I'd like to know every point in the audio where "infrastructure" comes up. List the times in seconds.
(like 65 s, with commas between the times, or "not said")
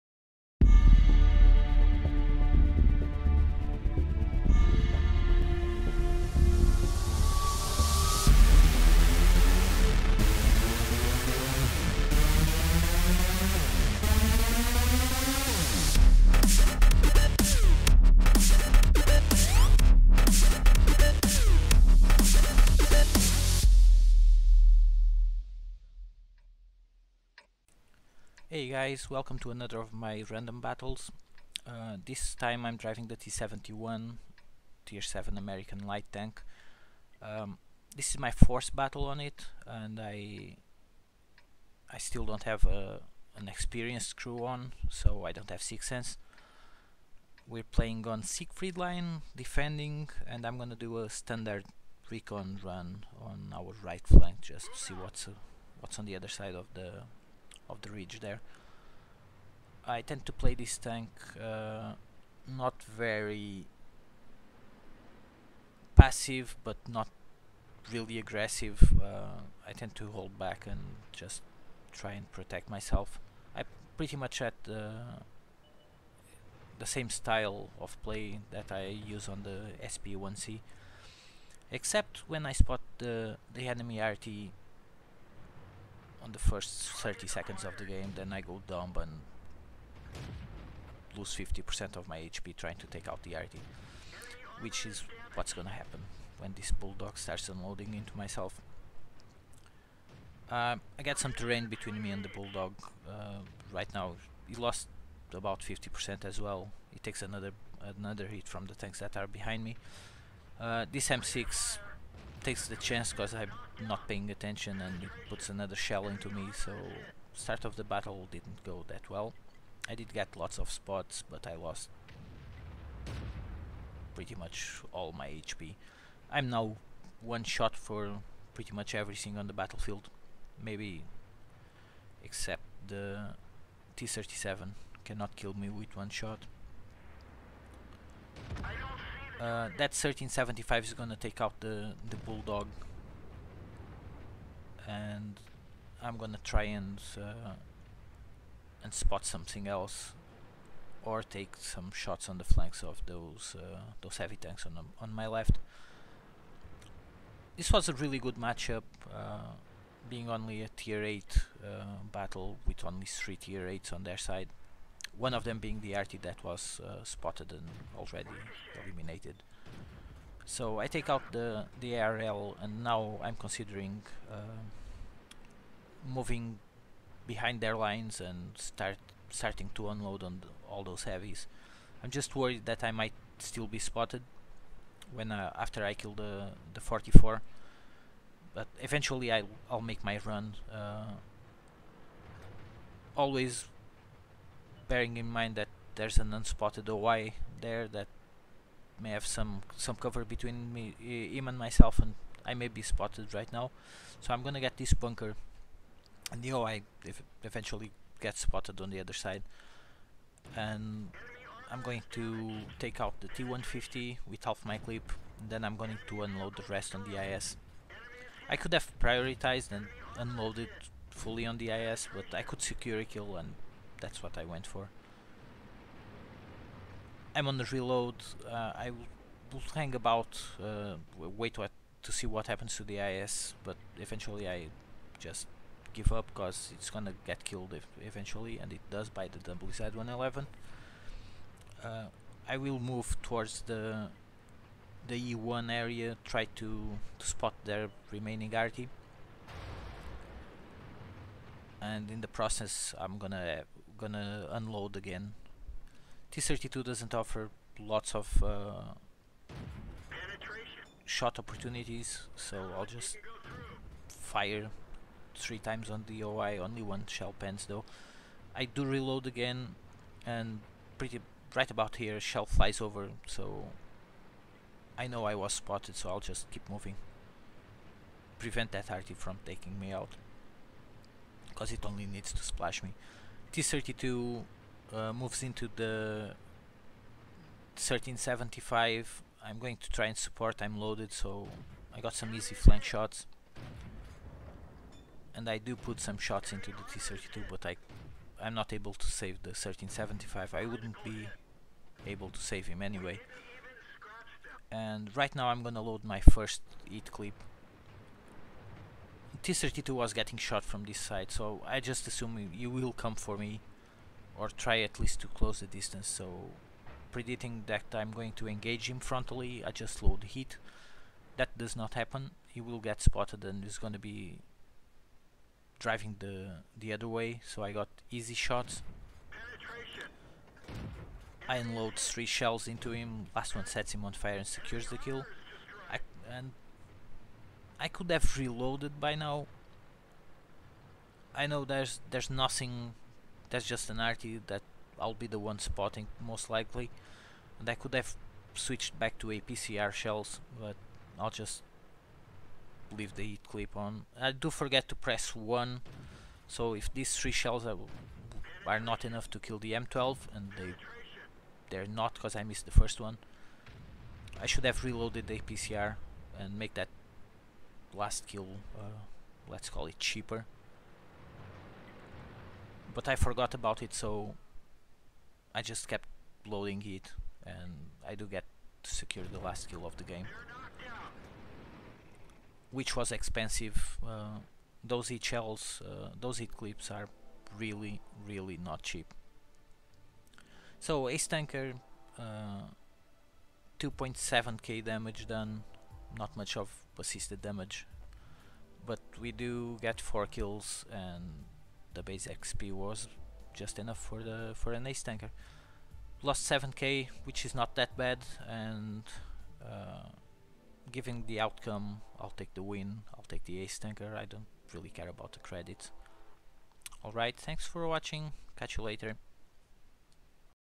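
not said.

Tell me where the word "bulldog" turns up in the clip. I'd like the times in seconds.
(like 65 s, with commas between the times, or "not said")
96 s, 102 s, 142 s.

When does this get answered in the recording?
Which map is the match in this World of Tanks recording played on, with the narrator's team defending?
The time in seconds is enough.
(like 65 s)
48 s.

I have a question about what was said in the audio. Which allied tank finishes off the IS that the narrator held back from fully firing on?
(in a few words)
WZ-111.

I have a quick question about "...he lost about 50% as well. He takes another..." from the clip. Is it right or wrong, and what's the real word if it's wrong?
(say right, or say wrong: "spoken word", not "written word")
right.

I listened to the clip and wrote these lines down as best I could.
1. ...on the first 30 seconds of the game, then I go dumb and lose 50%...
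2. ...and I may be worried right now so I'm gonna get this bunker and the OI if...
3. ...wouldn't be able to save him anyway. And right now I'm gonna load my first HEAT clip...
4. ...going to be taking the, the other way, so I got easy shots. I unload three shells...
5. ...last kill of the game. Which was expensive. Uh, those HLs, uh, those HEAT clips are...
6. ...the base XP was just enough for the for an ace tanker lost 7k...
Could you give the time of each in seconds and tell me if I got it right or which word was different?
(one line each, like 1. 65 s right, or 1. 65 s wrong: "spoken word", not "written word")
1. 86 s right
2. 201 s wrong: "spotted", not "worried"
3. 300 s right
4. 323 s wrong: "driving", not "taking"
5. 379 s right
6. 401 s right.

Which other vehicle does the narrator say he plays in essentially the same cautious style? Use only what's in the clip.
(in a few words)
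SP1C.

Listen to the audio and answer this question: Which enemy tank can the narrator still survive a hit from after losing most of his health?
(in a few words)
T-37.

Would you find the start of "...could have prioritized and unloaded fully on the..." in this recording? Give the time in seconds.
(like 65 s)
218 s.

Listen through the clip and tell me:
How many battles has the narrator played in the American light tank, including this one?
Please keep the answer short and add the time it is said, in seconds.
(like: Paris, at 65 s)
4, at 38 s.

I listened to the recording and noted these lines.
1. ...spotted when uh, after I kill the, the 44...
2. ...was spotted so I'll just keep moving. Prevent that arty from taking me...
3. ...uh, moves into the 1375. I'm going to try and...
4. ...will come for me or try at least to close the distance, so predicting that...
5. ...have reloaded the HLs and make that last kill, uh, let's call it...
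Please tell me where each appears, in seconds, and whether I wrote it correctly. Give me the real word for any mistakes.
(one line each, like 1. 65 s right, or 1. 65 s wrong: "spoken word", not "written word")
1. 183 s right
2. 275 s right
3. 284 s right
4. 312 s right
5. 364 s wrong: "APCR", not "HLs".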